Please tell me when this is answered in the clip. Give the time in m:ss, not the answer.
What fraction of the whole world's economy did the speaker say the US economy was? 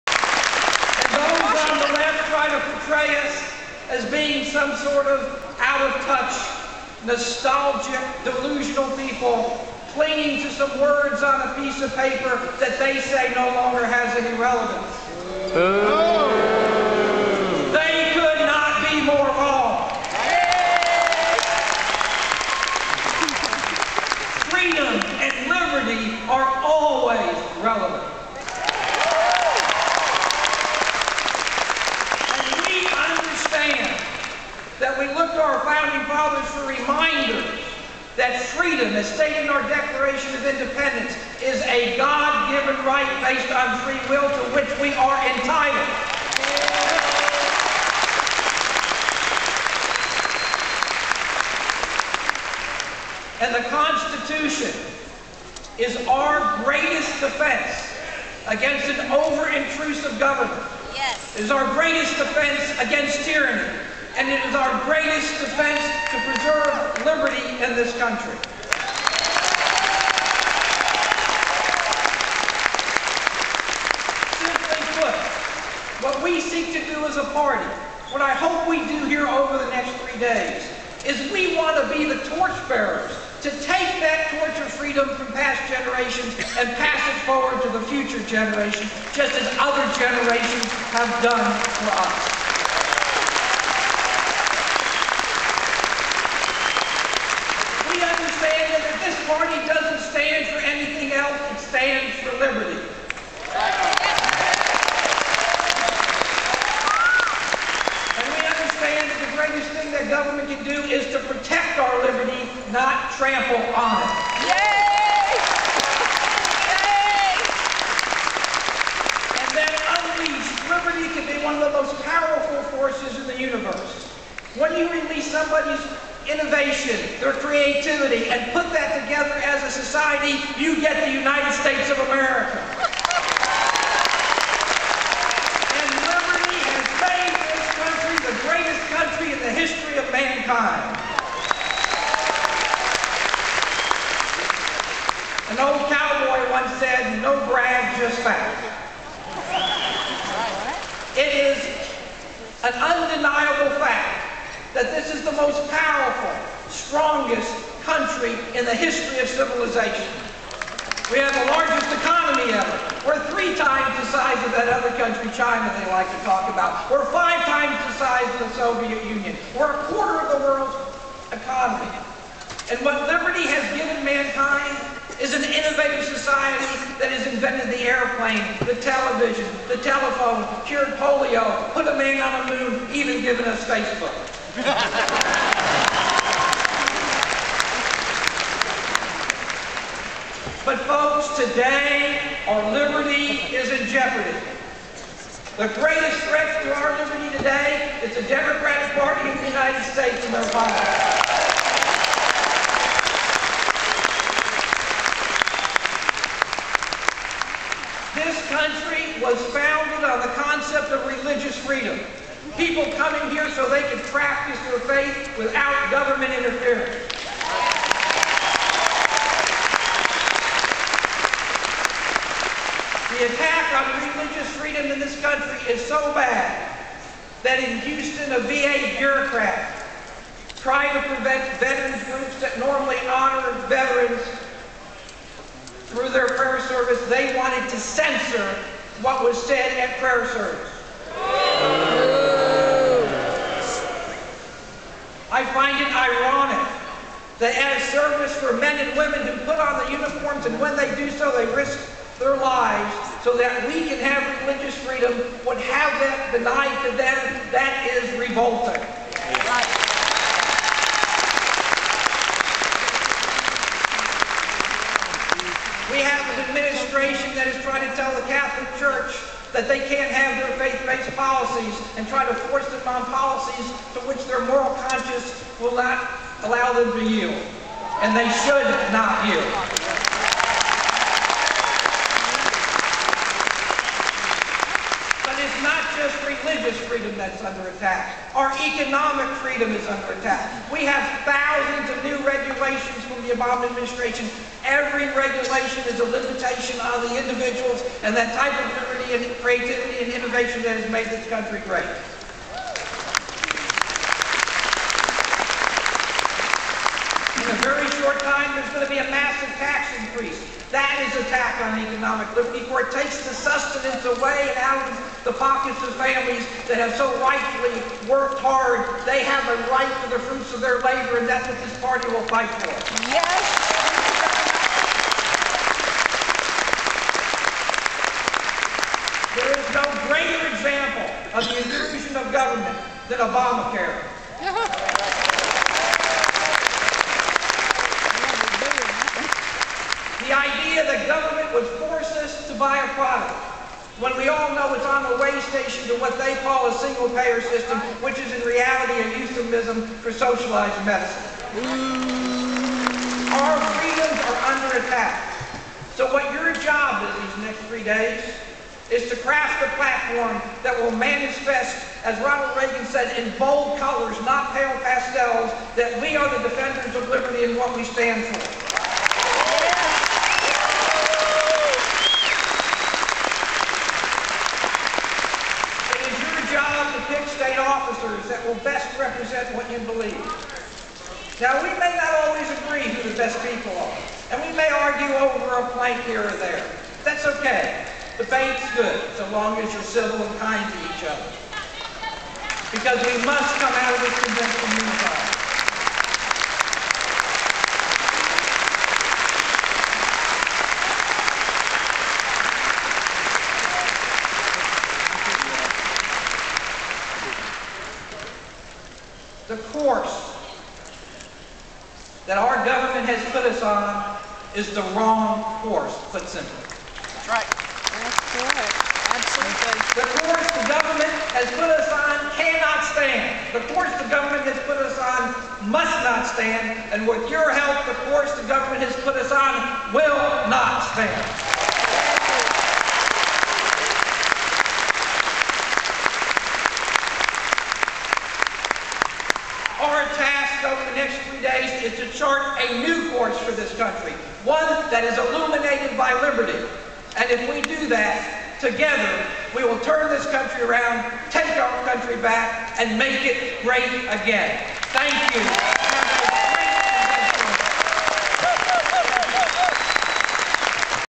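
2:49.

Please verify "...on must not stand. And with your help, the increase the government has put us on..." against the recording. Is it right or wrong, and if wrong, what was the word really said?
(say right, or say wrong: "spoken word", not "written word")
wrong: "course", not "increase".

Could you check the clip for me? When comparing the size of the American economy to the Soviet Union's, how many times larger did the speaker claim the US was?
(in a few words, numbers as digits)
5.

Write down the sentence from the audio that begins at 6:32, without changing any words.
Because we must come out of this convention unified.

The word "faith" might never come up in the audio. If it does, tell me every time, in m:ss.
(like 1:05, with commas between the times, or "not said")
3:34, 4:30.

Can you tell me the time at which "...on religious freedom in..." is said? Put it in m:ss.
3:43.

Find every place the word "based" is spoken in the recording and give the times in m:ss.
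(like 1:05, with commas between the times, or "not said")
0:43, 4:30.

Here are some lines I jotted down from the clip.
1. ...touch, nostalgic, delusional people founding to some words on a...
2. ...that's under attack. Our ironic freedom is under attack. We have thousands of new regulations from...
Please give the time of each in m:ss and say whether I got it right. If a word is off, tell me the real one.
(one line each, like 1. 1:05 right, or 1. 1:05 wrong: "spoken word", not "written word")
1. 0:06 wrong: "clinging", not "founding"
2. 4:47 wrong: "economic", not "ironic".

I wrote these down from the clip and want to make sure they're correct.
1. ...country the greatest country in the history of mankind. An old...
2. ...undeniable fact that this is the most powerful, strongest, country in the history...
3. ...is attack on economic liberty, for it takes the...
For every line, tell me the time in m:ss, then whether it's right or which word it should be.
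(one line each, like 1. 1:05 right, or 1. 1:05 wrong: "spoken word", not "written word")
1. 2:17 right
2. 2:32 right
3. 5:11 right.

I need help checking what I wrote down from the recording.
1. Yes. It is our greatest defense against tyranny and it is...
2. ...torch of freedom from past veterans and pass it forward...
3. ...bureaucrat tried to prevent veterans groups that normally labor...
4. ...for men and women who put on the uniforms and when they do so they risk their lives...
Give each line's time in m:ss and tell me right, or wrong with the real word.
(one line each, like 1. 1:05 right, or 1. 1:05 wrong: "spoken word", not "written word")
1. 1:00 right
2. 1:24 wrong: "generations", not "veterans"
3. 3:48 wrong: "honor", not "labor"
4. 4:08 right.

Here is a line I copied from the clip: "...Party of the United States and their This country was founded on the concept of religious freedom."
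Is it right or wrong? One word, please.
right.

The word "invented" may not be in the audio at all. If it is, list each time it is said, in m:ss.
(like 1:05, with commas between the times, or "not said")
2:57.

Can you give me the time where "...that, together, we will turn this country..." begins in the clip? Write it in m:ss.
7:27.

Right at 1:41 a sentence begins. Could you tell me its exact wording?
anything else, it stands for liberty.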